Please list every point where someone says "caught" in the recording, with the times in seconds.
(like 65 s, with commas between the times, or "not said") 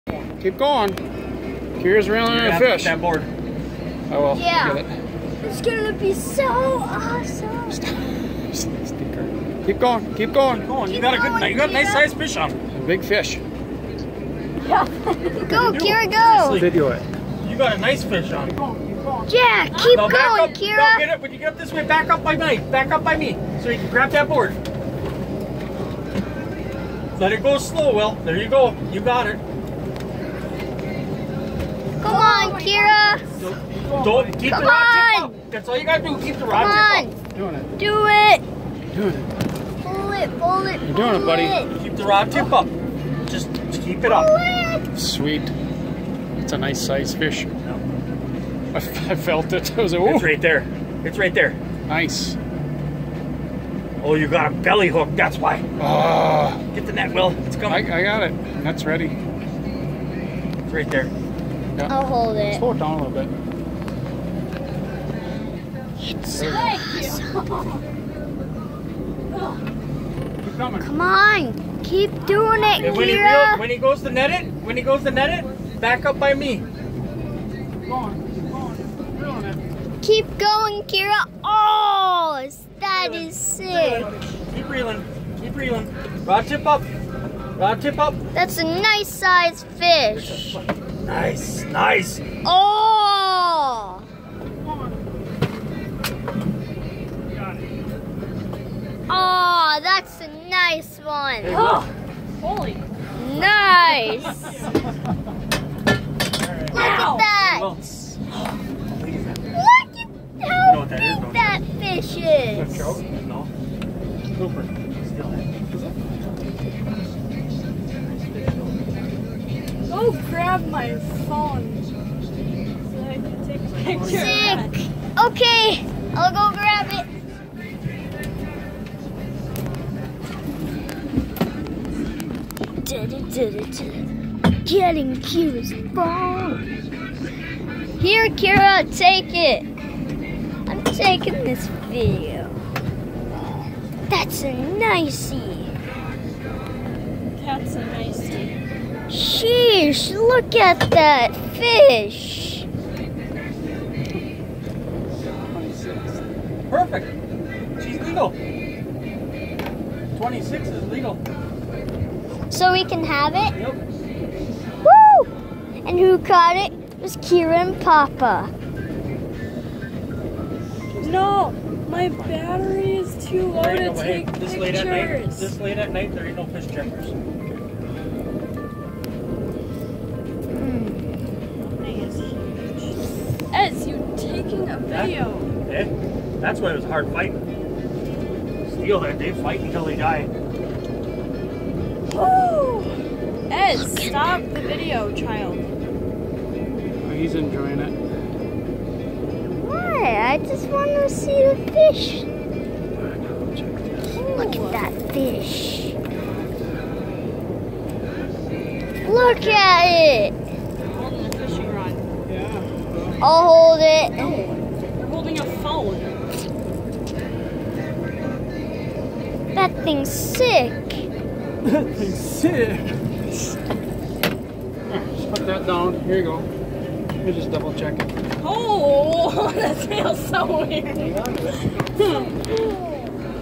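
166 s.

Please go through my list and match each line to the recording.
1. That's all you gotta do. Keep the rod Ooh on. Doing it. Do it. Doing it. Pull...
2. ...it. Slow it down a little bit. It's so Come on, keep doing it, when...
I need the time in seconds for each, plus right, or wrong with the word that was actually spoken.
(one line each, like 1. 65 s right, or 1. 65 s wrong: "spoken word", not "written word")
1. 35 s wrong: "Come", not "Ooh"
2. 62 s right.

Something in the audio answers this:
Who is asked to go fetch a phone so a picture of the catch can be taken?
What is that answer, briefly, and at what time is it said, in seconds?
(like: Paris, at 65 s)
Cooper, at 114 s.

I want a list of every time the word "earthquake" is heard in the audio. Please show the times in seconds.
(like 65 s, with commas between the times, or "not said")
not said.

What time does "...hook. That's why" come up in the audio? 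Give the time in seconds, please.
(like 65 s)
54 s.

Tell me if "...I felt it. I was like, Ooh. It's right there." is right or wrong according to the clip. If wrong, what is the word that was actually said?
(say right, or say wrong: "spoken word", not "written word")
right.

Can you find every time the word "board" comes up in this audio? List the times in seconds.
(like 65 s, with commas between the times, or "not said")
2 s, 24 s.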